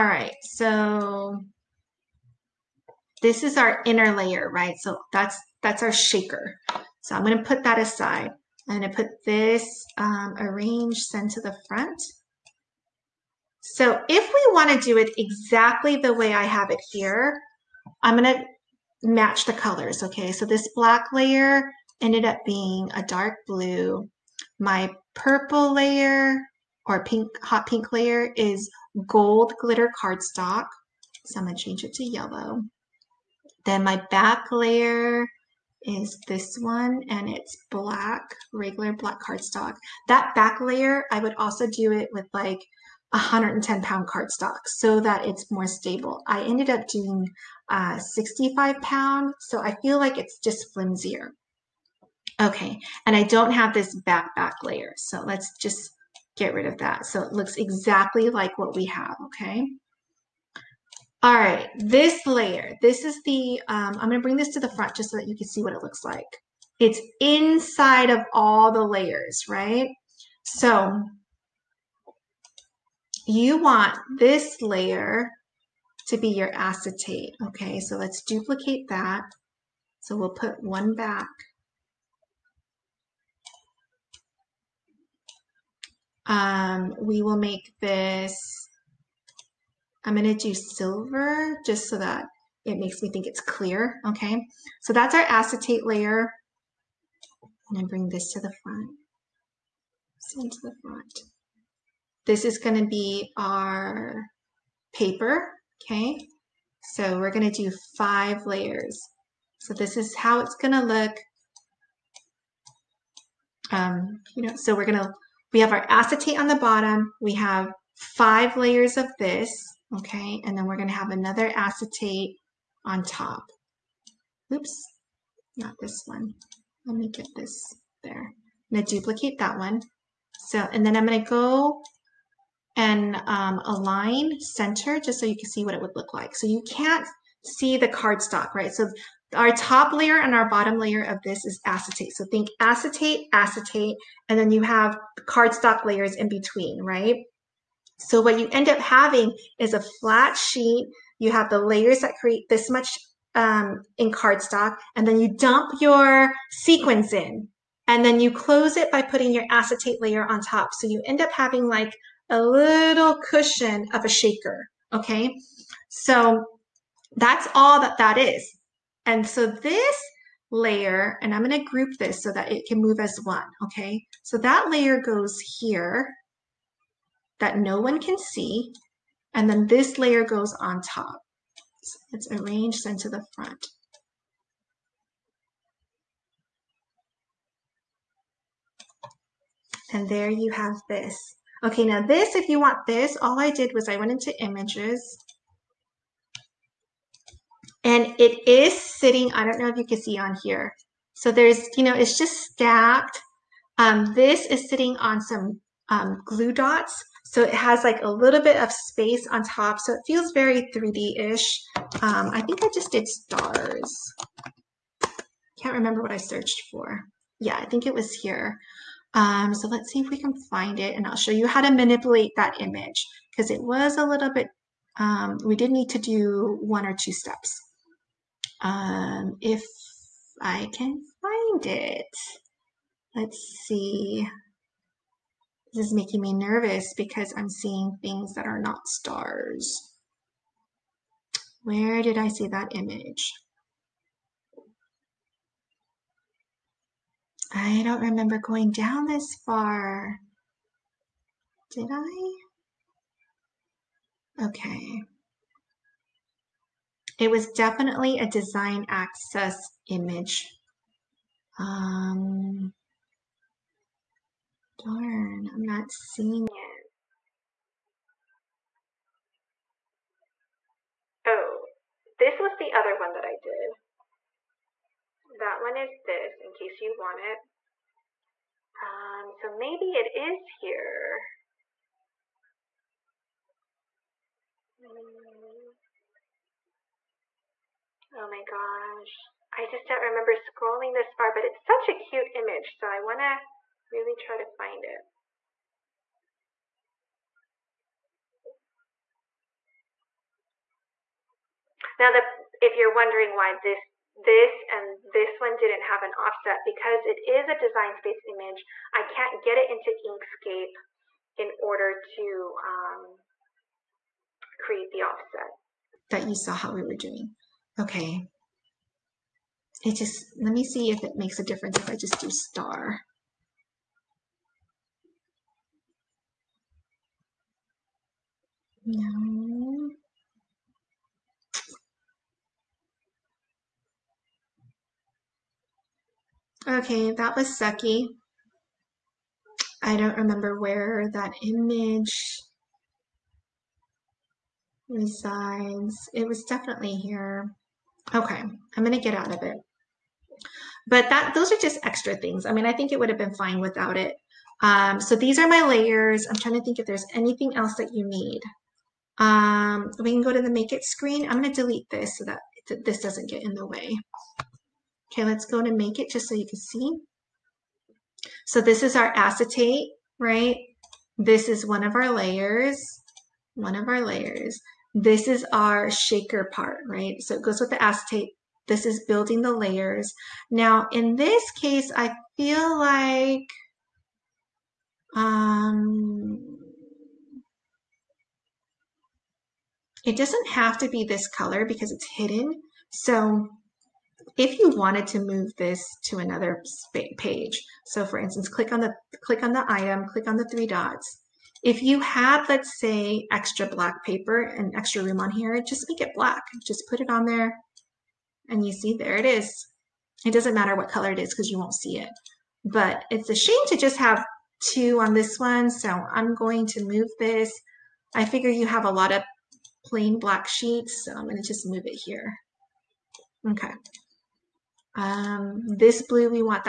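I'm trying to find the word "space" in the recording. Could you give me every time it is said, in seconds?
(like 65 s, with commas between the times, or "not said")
208 s, 307 s.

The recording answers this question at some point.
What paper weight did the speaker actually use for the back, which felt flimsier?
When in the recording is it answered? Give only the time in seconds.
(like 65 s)
47 s.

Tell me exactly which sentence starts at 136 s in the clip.
So you can't see the cardstock, right?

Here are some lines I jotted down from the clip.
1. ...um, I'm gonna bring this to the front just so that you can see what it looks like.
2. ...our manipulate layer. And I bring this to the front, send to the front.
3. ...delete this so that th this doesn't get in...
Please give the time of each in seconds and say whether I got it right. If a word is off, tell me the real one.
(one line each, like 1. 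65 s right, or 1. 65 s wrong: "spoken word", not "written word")
1. 63 s right
2. 95 s wrong: "acetate", not "manipulate"
3. 361 s right.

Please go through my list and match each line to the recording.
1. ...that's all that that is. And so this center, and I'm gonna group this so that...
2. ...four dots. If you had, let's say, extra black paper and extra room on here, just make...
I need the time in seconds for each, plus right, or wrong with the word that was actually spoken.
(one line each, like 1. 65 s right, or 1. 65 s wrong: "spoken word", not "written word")
1. 167 s wrong: "layer", not "center"
2. 400 s wrong: "three", not "four".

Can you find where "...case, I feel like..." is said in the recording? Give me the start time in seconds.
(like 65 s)
381 s.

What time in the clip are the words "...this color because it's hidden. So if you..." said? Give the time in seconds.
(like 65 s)
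391 s.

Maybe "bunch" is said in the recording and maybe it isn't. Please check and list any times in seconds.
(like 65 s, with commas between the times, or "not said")
not said.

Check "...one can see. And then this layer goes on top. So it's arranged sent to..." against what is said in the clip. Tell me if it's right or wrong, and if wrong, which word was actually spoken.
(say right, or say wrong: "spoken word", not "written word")
right.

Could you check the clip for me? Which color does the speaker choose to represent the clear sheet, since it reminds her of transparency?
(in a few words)
Silver.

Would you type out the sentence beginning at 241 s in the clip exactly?
Where did I see that image?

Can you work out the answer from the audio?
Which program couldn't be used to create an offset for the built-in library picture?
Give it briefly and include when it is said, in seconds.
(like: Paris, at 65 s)
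Inkscape, at 310 s.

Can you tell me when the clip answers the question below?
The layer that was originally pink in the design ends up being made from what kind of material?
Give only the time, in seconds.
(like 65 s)
29 s.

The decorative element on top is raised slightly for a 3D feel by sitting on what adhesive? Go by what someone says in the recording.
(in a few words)
Glue dots.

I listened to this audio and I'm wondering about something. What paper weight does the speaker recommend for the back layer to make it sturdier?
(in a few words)
110 pound.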